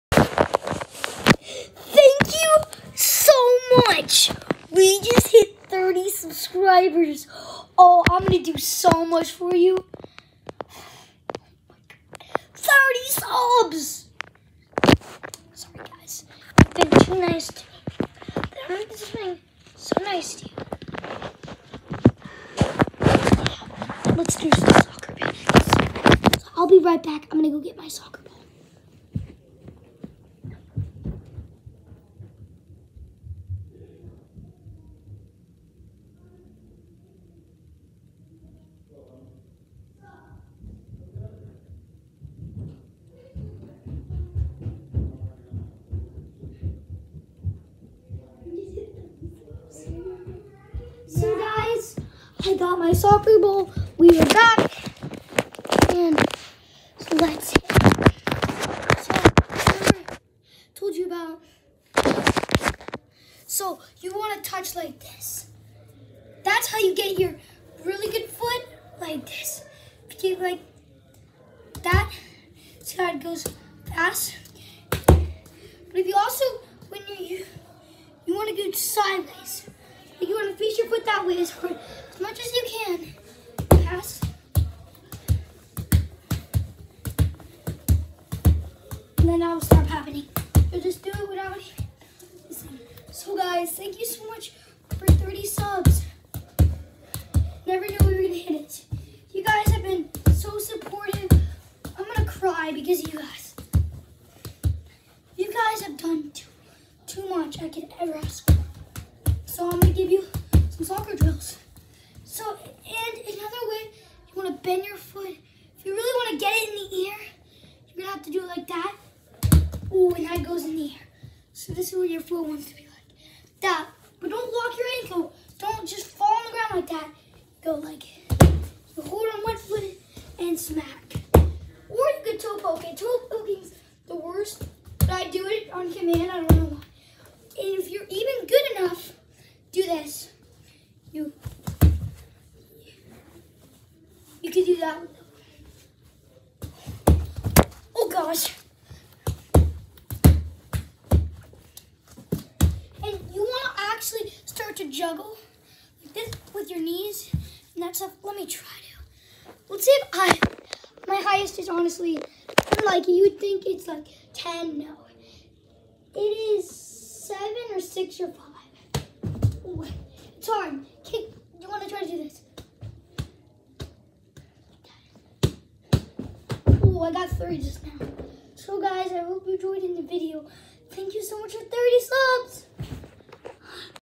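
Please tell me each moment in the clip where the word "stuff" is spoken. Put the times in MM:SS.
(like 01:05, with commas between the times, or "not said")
02:37.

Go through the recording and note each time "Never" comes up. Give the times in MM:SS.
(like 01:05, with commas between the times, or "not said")
01:37.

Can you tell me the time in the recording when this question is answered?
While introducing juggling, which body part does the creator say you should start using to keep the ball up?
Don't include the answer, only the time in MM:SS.
02:36.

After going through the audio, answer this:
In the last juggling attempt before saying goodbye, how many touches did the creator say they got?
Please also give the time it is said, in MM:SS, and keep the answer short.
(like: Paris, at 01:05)
3, at 02:57.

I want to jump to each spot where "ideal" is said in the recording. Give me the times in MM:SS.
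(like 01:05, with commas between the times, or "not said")
not said.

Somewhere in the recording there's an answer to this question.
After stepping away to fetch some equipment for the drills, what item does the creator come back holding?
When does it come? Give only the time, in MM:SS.
00:52.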